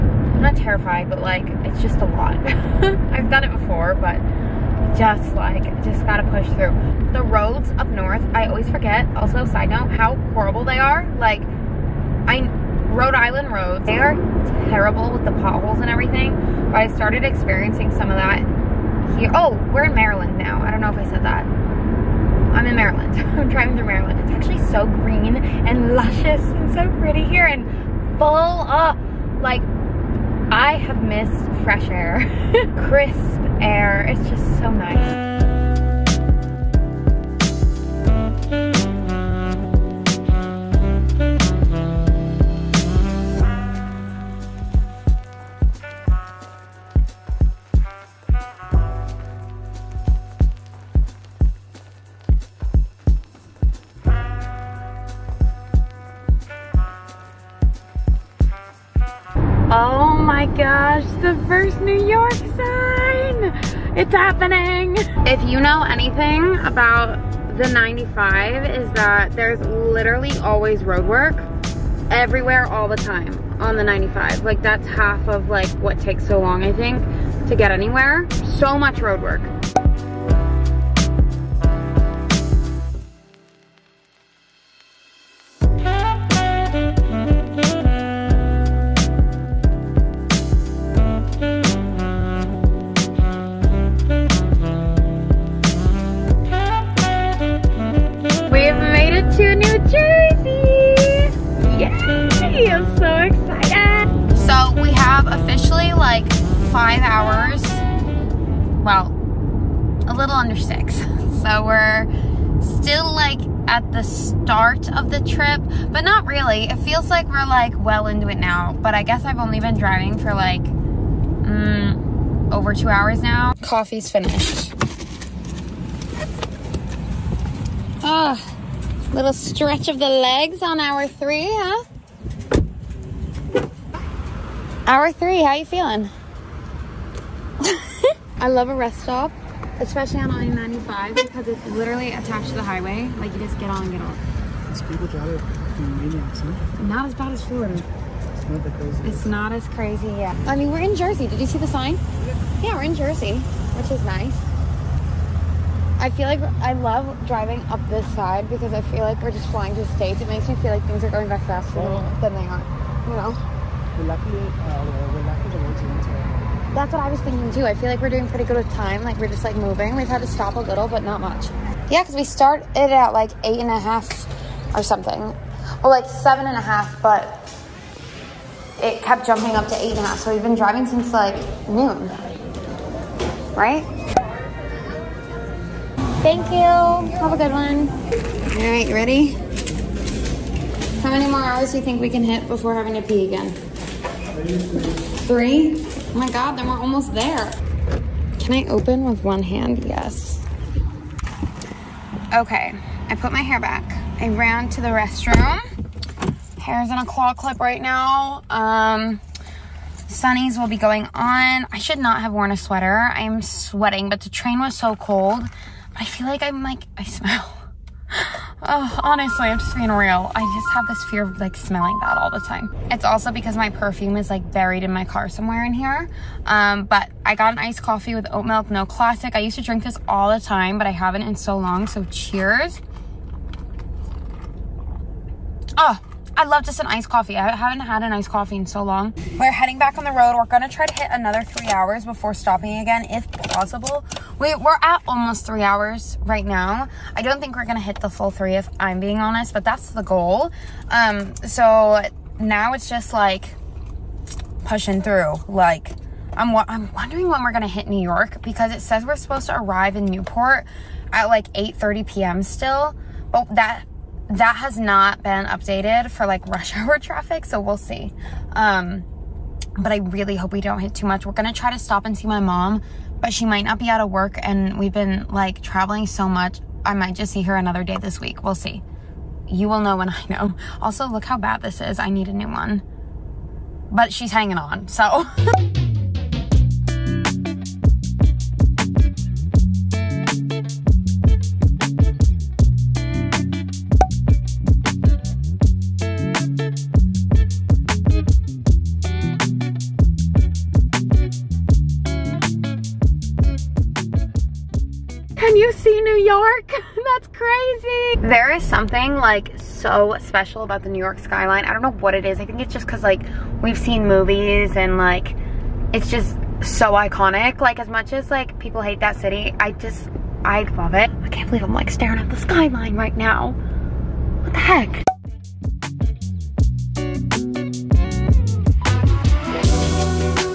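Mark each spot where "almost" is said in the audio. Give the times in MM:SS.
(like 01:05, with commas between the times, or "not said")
03:16, 04:05.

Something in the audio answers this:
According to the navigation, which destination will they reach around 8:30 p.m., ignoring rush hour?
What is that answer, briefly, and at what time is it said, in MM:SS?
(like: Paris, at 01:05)
Newport, at 04:20.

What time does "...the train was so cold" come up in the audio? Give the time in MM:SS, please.
03:34.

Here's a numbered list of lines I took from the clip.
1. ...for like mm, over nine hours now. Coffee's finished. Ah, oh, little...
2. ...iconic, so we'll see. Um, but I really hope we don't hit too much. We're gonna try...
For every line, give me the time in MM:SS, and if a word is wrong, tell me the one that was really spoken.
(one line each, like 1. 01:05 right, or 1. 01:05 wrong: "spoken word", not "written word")
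1. 02:00 wrong: "two", not "nine"
2. 04:26 wrong: "traffic", not "iconic".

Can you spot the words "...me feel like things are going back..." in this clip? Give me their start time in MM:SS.
02:40.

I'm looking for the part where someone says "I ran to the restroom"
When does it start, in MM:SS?
03:24.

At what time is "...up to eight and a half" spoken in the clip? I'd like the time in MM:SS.
02:59.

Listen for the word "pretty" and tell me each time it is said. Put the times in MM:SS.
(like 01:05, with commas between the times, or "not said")
00:26, 02:48.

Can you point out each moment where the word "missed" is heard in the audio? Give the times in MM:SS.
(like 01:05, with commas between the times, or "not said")
00:31.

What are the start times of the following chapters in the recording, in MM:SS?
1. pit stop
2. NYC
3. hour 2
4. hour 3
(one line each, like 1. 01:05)
1. 02:02
2. 05:07
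3. 00:34
4. 04:44.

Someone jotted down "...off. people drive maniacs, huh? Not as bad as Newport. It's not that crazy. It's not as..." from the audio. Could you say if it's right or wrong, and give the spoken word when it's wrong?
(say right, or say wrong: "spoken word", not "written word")
wrong: "Florida", not "Newport".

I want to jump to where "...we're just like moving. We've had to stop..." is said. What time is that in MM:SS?
02:49.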